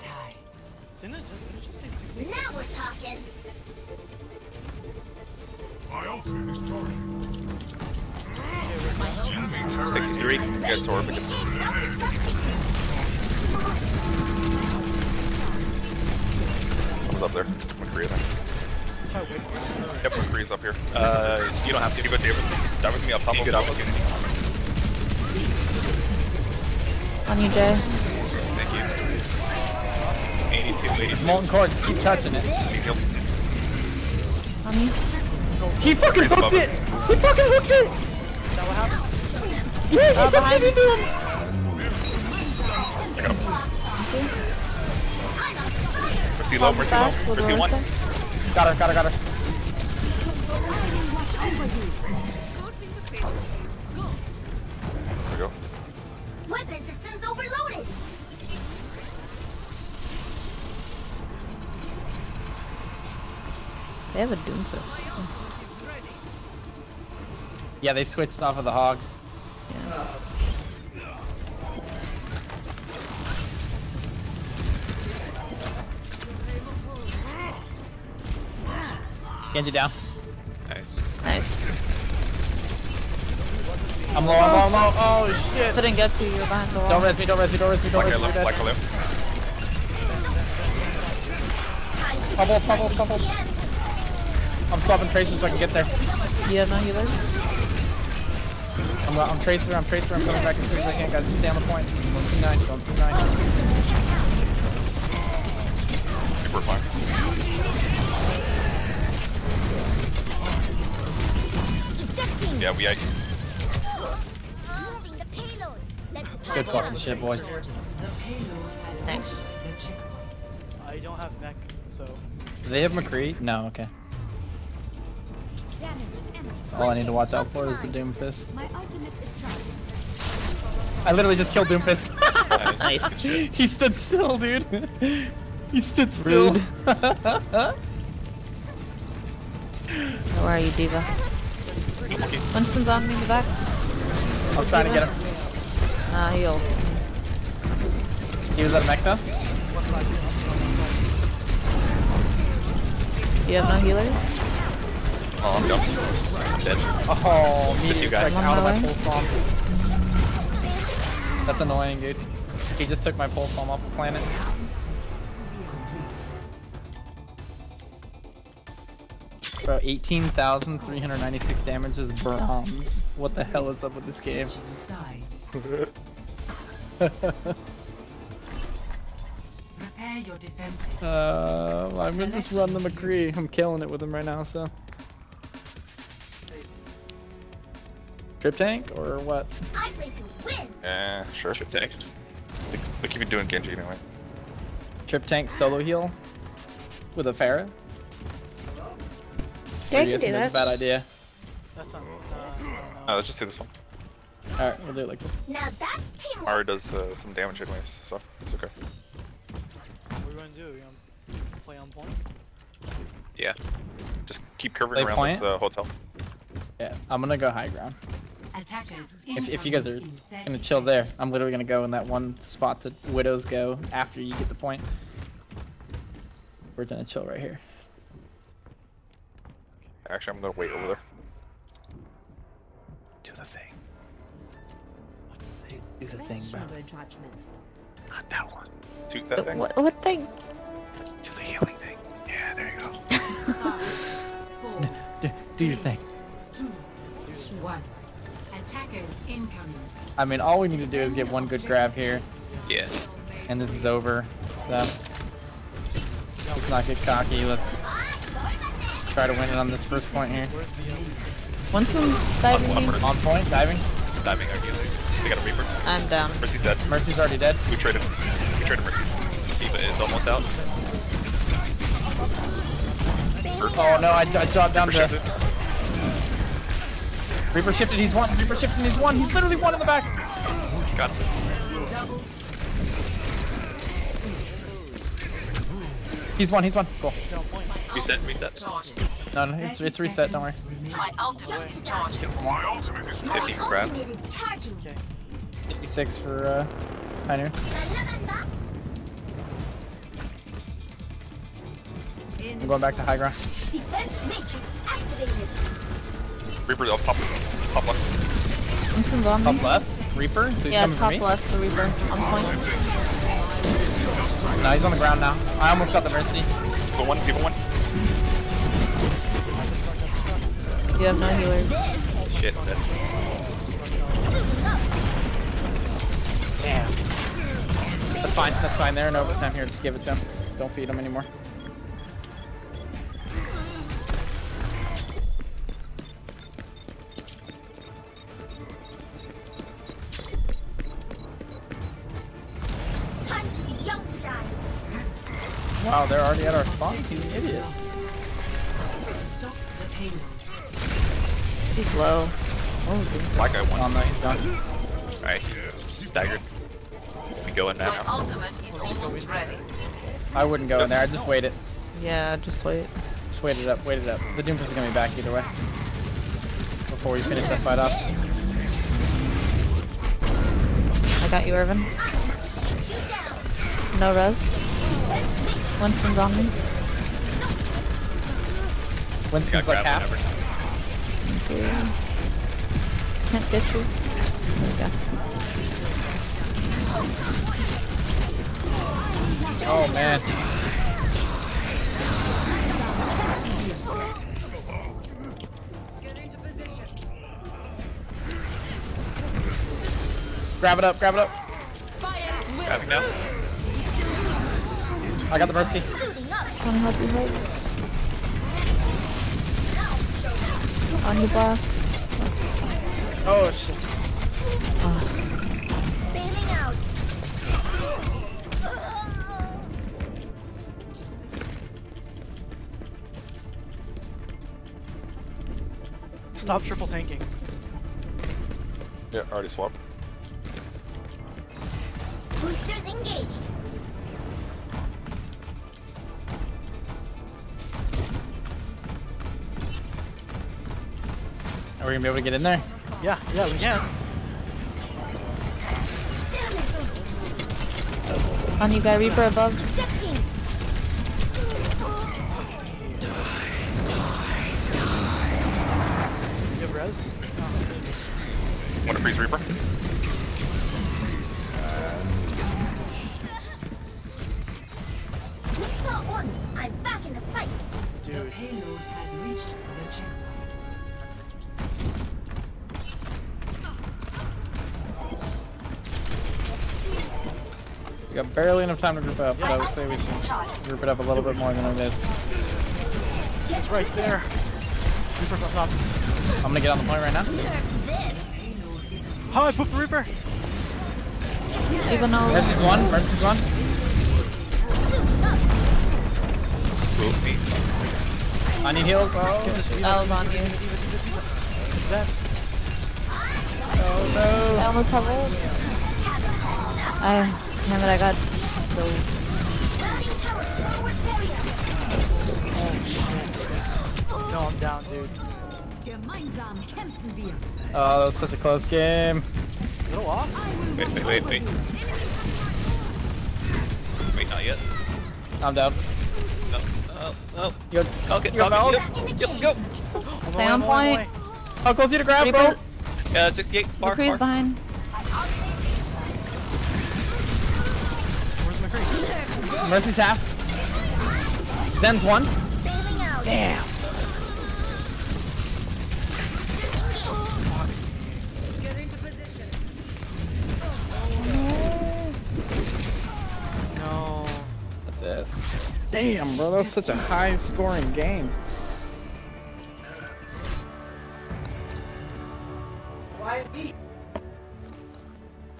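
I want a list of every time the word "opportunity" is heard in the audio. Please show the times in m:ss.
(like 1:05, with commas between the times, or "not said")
0:23.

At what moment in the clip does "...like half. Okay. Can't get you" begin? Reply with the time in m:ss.
6:19.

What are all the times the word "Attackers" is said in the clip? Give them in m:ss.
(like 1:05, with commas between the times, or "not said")
3:38.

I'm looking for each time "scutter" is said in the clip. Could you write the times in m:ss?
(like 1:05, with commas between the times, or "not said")
not said.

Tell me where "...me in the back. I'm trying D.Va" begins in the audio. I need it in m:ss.
2:23.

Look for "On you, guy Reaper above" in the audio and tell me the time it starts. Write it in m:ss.
7:28.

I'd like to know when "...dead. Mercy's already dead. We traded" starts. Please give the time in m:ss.
4:26.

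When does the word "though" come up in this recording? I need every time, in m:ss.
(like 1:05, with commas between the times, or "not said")
8:12.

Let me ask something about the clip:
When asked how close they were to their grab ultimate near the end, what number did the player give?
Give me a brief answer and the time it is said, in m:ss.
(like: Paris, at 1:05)
68, at 8:53.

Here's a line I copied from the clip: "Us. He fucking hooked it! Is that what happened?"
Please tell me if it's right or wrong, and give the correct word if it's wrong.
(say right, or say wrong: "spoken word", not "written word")
right.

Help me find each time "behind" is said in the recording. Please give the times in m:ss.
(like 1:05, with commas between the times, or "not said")
1:26, 8:54.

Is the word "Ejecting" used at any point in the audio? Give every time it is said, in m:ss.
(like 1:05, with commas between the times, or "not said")
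1:52.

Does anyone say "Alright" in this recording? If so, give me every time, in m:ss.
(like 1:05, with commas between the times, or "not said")
5:55.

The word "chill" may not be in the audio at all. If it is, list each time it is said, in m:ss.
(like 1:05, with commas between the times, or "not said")
3:40, 3:47.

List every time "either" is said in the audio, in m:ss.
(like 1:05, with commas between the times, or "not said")
6:05.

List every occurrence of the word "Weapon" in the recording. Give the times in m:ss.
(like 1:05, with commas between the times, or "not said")
0:56.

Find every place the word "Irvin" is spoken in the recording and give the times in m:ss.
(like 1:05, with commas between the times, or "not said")
6:11.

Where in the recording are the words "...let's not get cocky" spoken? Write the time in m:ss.
4:14.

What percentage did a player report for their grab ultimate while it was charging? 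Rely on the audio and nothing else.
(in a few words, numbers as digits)
50.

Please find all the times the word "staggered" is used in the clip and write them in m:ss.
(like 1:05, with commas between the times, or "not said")
5:55.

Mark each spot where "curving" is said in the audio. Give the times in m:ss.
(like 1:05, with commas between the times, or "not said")
3:34.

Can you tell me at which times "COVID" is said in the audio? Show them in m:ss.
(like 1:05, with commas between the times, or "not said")
not said.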